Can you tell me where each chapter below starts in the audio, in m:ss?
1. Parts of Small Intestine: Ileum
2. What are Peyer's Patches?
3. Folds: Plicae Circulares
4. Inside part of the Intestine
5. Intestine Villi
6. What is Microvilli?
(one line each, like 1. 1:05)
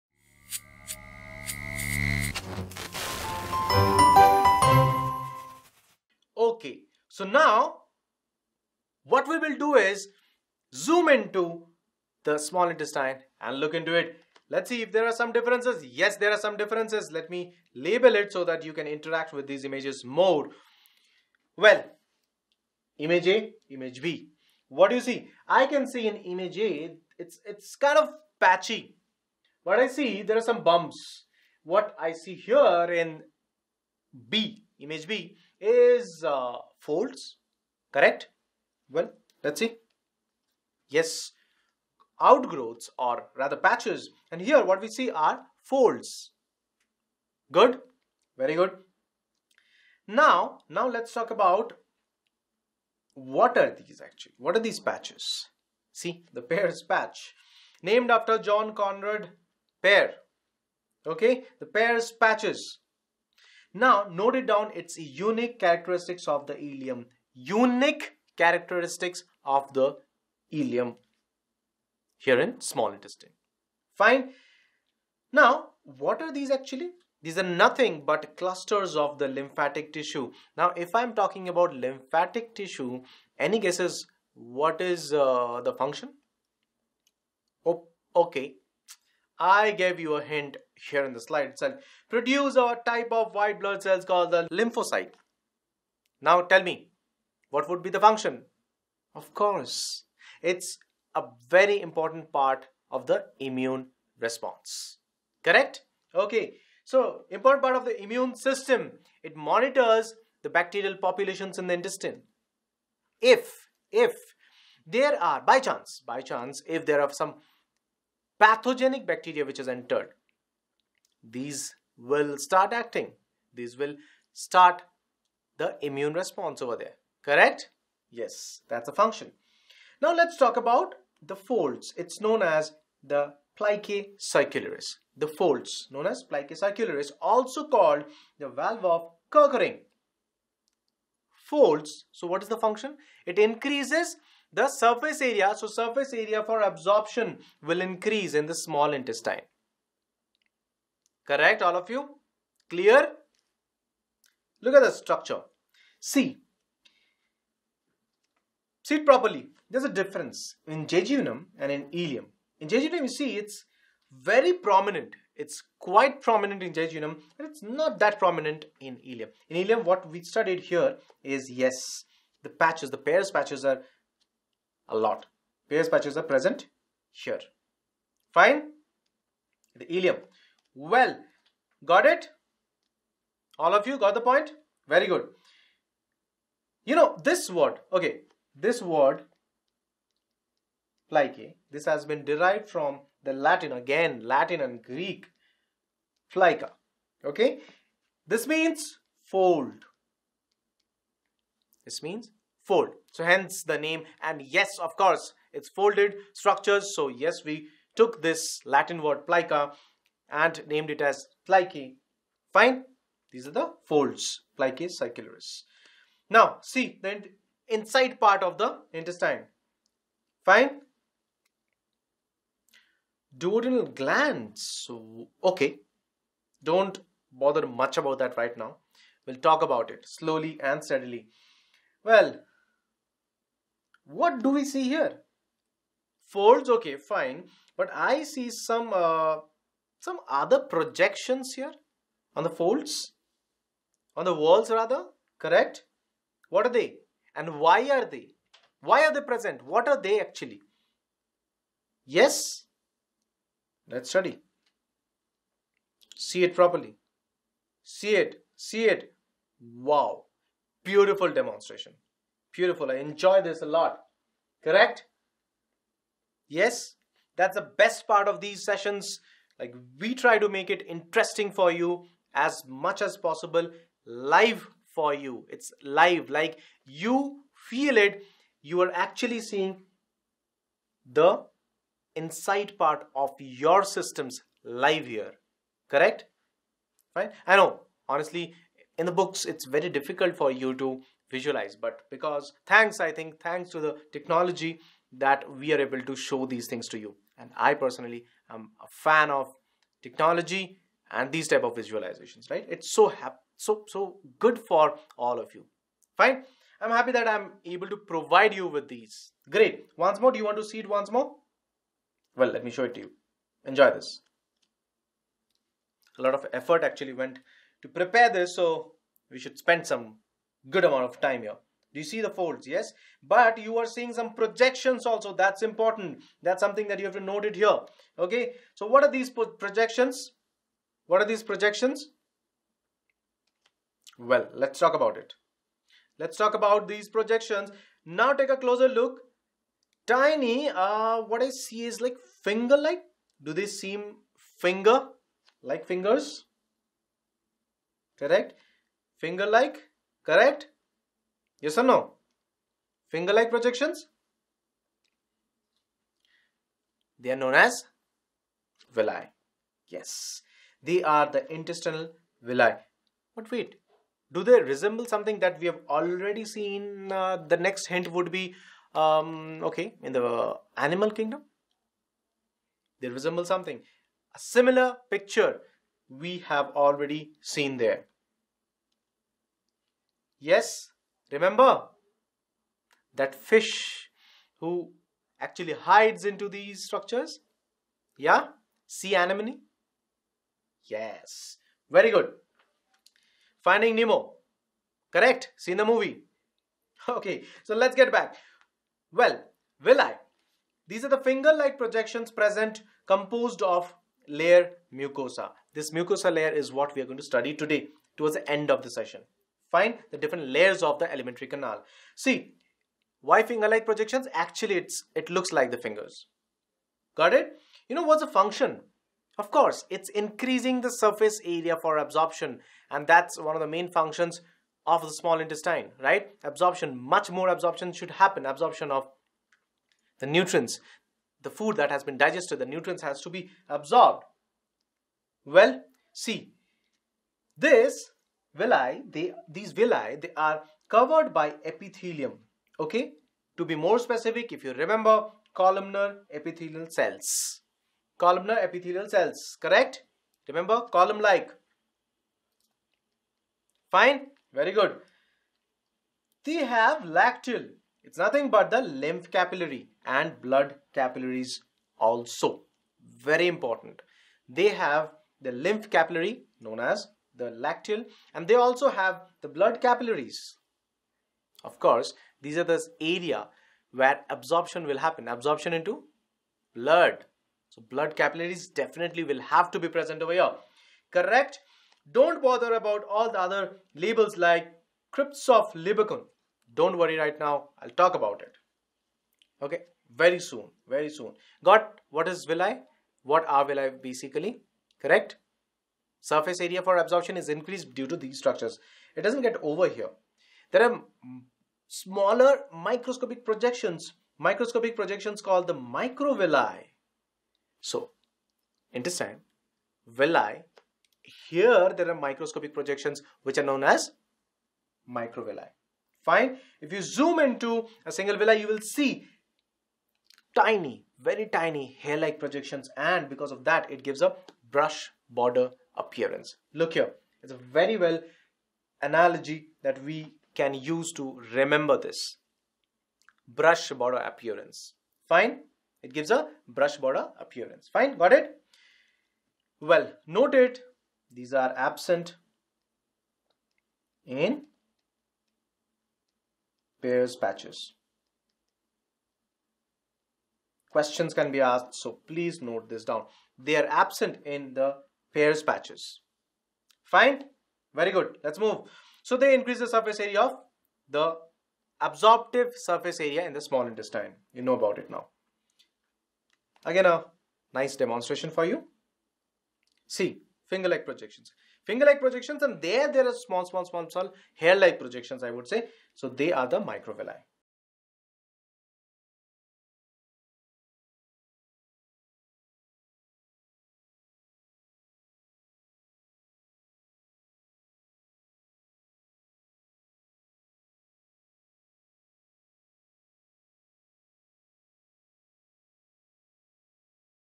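1. 0:14
2. 0:54
3. 2:11
4. 3:36
5. 5:56
6. 8:19.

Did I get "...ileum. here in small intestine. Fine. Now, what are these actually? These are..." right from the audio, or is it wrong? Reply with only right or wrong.
right.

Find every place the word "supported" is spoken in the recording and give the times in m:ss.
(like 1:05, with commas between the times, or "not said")
not said.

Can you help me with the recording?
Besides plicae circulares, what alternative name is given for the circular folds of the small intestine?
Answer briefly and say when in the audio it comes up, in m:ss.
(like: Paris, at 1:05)
valve of Kerkring, at 2:18.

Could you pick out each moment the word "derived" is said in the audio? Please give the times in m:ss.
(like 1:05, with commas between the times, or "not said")
3:12.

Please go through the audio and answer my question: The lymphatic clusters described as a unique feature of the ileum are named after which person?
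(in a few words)
John Conrad Peyer.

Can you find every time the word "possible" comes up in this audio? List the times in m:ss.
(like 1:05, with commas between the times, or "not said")
4:33.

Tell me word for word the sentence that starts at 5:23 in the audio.
But you are seeing some projections also.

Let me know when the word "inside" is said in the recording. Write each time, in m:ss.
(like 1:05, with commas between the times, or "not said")
3:37, 4:42.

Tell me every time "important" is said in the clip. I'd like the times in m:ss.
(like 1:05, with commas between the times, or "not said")
1:41, 1:47, 5:25, 7:43.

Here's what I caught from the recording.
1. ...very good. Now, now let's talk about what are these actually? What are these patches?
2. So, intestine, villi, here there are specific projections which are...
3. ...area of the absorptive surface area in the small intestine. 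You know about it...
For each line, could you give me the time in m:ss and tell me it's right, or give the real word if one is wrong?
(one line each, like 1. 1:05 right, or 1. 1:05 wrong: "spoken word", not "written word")
1. 0:48 right
2. 8:27 wrong: "microscopic", not "specific"
3. 9:20 right.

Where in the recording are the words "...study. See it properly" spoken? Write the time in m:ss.
4:14.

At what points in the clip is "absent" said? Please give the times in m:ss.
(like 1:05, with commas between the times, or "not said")
9:01, 9:13.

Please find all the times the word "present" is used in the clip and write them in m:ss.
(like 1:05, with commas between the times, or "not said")
2:56, 4:09, 6:42, 7:59.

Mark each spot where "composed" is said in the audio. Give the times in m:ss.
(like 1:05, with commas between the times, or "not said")
6:43.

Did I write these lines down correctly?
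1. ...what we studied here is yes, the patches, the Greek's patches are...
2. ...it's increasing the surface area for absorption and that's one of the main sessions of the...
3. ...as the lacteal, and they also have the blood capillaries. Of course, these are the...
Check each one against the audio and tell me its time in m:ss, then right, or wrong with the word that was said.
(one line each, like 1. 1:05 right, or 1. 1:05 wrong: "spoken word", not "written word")
1. 2:49 wrong: "Peyer", not "Greek"
2. 6:59 wrong: "functions", not "sessions"
3. 7:46 right.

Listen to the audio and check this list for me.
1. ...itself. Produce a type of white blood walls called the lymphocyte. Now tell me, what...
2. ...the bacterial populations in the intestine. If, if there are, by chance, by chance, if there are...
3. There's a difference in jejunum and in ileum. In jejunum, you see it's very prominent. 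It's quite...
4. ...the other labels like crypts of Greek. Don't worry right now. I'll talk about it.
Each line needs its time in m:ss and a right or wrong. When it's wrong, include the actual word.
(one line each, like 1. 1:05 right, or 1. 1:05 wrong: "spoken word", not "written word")
1. 1:31 wrong: "cells", not "walls"
2. 1:50 right
3. 2:39 right
4. 8:03 wrong: "Lieberkühn", not "Greek".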